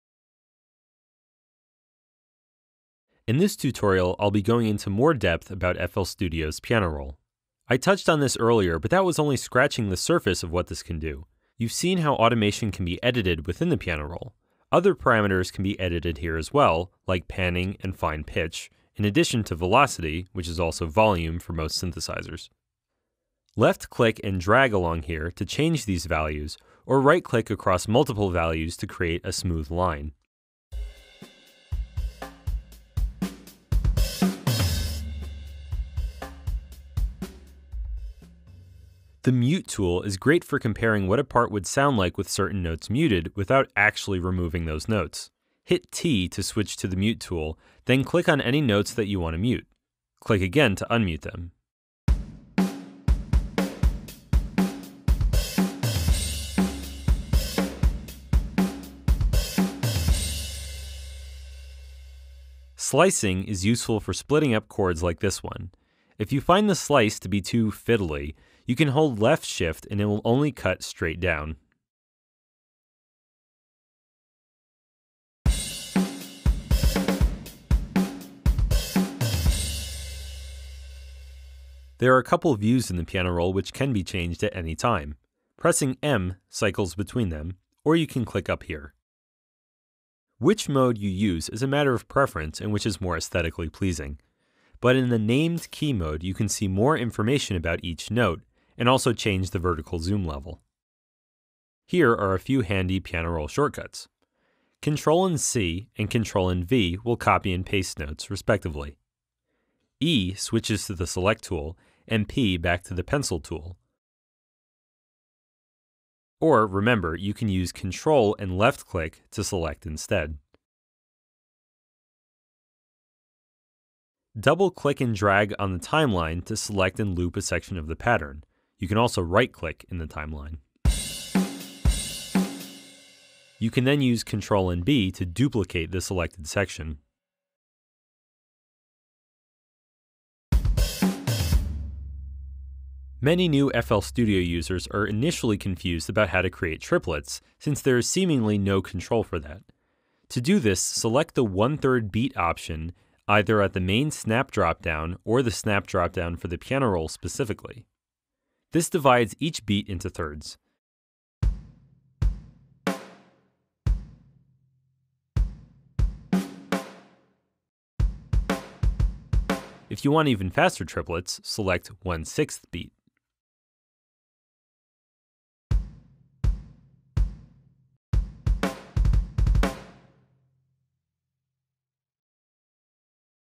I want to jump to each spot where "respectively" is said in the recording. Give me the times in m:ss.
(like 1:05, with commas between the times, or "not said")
1:48.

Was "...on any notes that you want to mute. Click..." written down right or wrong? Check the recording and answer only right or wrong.
right.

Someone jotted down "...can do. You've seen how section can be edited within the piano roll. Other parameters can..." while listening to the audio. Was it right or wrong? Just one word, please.
wrong.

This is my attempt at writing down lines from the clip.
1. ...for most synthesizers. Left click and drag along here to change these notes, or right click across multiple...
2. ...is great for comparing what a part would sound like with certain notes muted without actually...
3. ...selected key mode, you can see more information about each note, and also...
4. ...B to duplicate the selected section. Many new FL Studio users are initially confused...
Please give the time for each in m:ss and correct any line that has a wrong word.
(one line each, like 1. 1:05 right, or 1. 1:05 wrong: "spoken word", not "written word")
1. 0:21 wrong: "values", not "notes"
2. 0:40 right
3. 1:35 wrong: "named", not "selected"
4. 2:14 right.